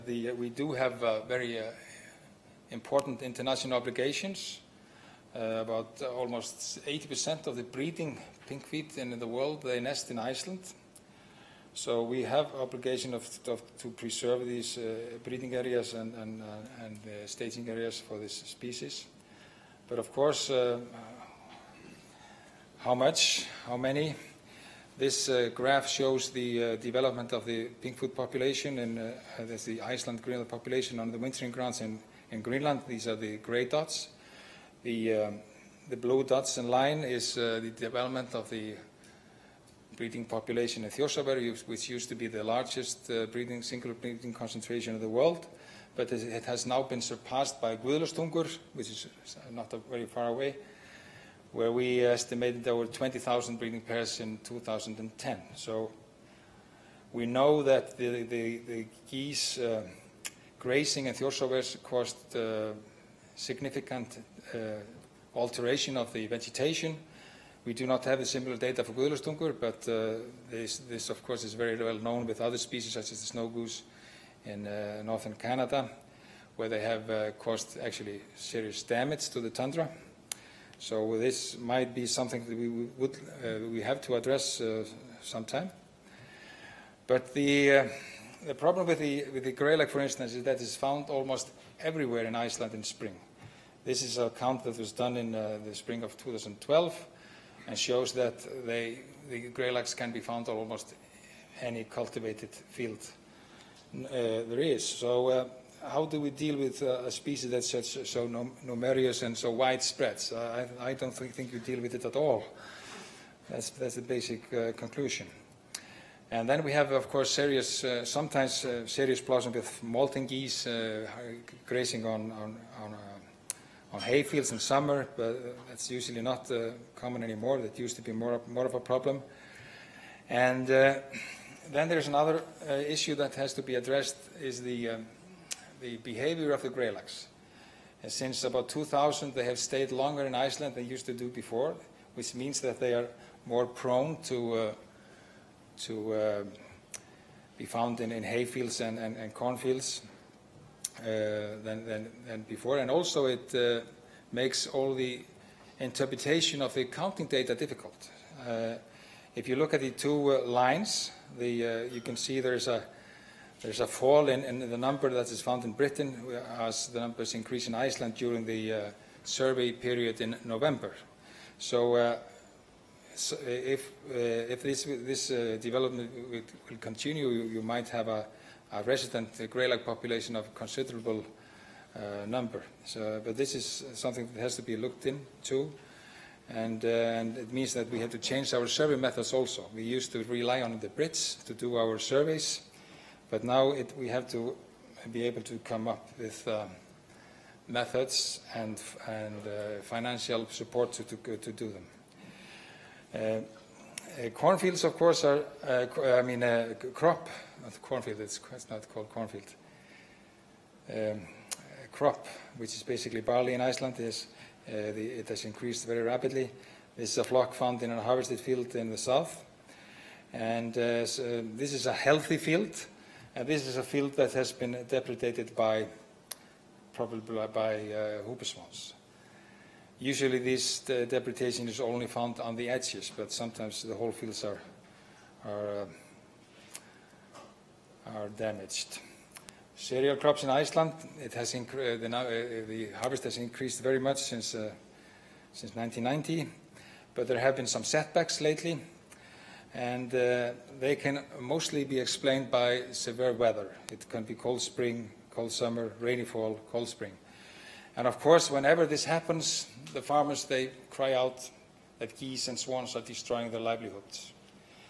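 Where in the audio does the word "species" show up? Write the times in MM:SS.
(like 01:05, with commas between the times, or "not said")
00:18, 01:12, 01:47.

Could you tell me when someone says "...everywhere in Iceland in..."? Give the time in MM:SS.
01:31.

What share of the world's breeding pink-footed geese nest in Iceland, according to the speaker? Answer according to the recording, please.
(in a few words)
almost 80%.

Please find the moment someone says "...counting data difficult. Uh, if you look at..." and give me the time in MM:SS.
02:36.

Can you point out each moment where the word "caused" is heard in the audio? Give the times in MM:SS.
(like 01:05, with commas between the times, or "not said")
01:01, 01:17.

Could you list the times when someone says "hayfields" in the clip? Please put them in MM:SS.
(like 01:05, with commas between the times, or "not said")
02:04, 02:28.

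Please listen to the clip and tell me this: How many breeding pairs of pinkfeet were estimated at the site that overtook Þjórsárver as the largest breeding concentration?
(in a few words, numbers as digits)
20,000.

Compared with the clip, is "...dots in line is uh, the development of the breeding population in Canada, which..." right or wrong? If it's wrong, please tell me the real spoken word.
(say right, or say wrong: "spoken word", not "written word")
wrong: "Þjórsárver", not "Canada".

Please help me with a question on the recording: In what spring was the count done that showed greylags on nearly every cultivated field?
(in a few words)
2012.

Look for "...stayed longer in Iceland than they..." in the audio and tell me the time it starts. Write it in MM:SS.
02:19.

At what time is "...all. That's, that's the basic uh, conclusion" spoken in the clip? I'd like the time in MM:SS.
01:52.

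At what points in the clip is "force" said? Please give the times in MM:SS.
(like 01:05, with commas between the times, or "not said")
not said.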